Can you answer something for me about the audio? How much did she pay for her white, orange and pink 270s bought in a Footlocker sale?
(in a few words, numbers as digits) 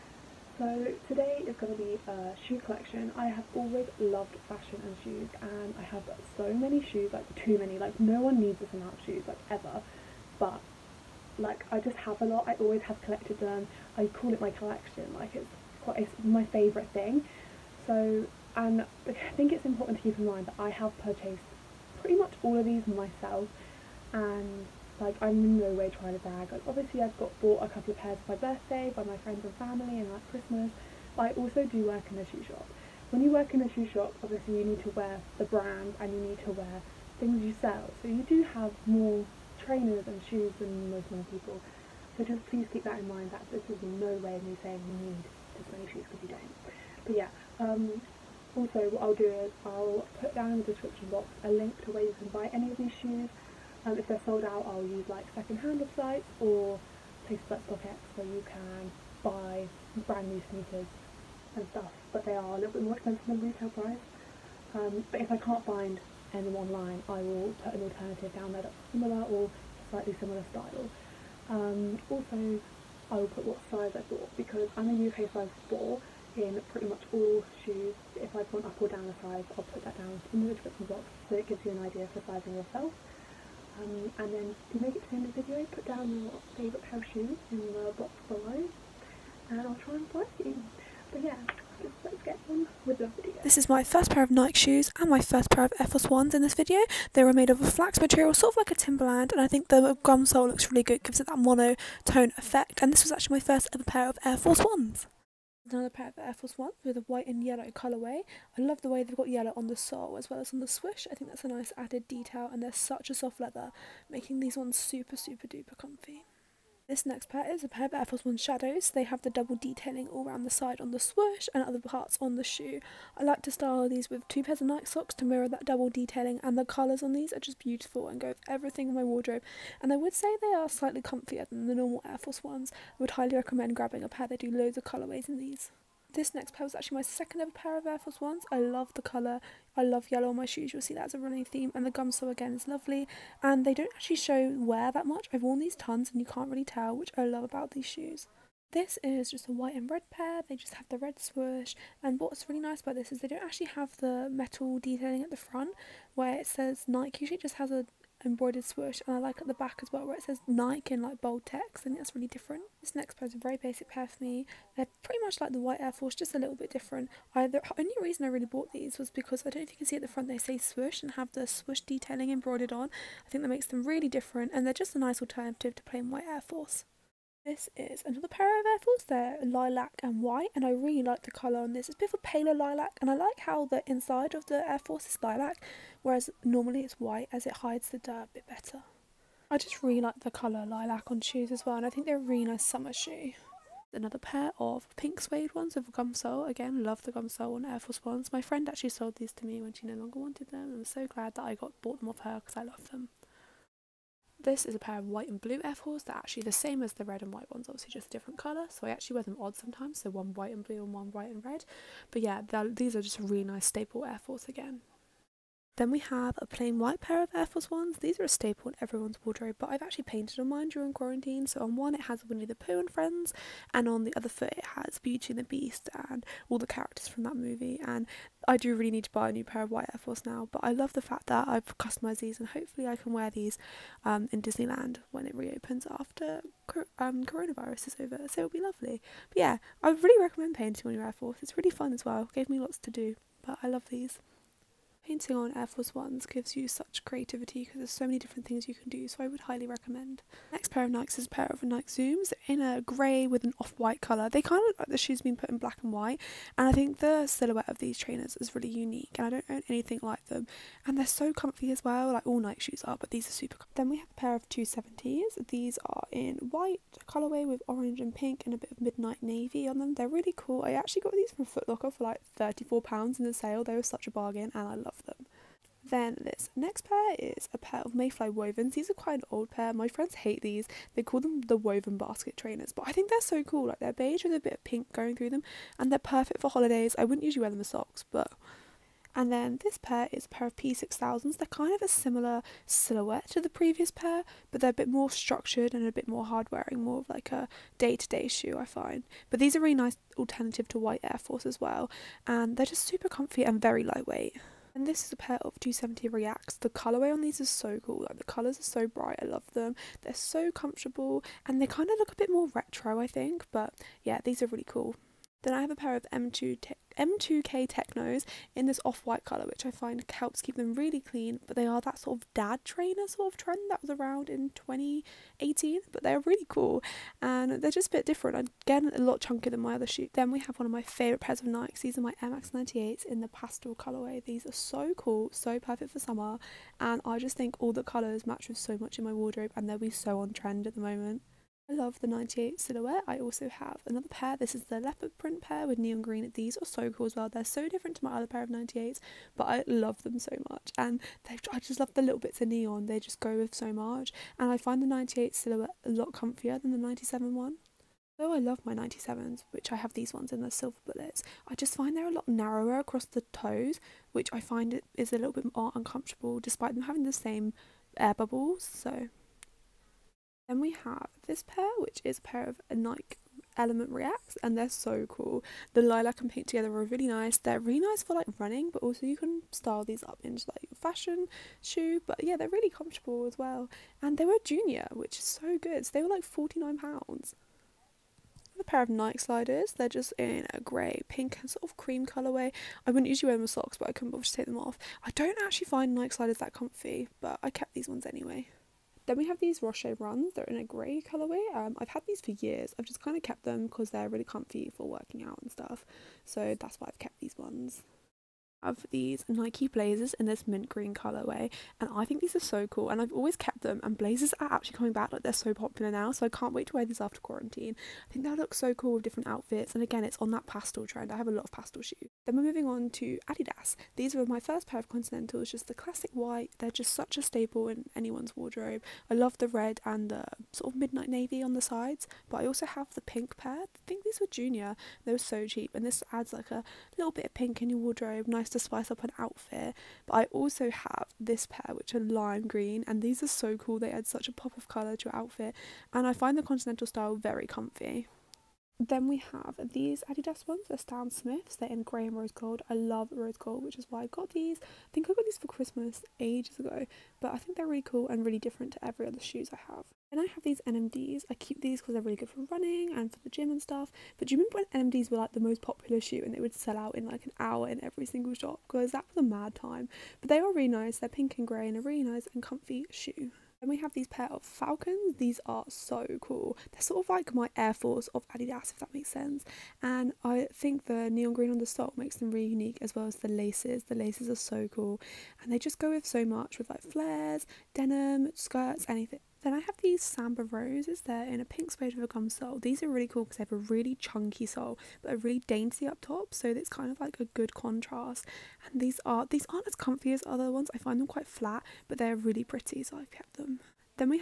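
£34.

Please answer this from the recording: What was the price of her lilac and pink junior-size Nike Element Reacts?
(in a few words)
£49.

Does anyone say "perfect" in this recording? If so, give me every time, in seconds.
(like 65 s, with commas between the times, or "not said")
285 s, 335 s.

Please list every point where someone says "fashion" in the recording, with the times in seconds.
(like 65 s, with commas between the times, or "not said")
4 s, 380 s.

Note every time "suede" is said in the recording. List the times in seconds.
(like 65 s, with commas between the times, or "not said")
195 s, 491 s.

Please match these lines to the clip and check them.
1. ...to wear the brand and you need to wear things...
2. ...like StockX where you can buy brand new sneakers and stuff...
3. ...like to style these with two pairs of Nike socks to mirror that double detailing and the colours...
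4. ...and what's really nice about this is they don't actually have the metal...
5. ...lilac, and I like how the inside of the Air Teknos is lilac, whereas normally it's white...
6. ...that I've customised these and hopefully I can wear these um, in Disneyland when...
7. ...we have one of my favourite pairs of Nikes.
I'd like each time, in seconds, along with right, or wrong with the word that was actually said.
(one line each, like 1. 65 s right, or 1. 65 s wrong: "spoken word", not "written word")
1. 34 s right
2. 57 s right
3. 123 s right
4. 152 s right
5. 182 s wrong: "Force", not "Teknos"
6. 231 s right
7. 330 s right.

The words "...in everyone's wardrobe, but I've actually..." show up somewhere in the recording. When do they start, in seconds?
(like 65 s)
218 s.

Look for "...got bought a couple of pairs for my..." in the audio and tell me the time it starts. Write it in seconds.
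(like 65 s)
27 s.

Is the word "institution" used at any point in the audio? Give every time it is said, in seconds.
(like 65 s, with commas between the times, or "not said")
not said.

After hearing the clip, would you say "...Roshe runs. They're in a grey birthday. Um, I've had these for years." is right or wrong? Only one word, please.
wrong.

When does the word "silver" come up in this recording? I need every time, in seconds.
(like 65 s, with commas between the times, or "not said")
360 s.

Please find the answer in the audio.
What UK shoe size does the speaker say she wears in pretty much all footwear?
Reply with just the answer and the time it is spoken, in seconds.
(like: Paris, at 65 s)
4, at 75 s.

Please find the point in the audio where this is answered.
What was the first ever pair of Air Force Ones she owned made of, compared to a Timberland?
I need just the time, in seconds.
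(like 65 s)
97 s.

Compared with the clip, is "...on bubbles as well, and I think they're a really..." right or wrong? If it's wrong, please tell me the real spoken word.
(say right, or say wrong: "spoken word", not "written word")
wrong: "shoes", not "bubbles".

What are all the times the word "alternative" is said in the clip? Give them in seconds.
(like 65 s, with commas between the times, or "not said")
67 s, 175 s, 300 s.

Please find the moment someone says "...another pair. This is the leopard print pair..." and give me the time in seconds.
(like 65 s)
343 s.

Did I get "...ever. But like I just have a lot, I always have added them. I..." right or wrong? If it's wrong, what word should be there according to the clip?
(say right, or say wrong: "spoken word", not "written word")
wrong: "collected", not "added".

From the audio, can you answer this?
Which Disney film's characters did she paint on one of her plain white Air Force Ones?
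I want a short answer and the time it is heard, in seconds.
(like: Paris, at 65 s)
Beauty and the Beast, at 224 s.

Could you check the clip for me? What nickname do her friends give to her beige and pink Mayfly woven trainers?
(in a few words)
Woven basket trainers.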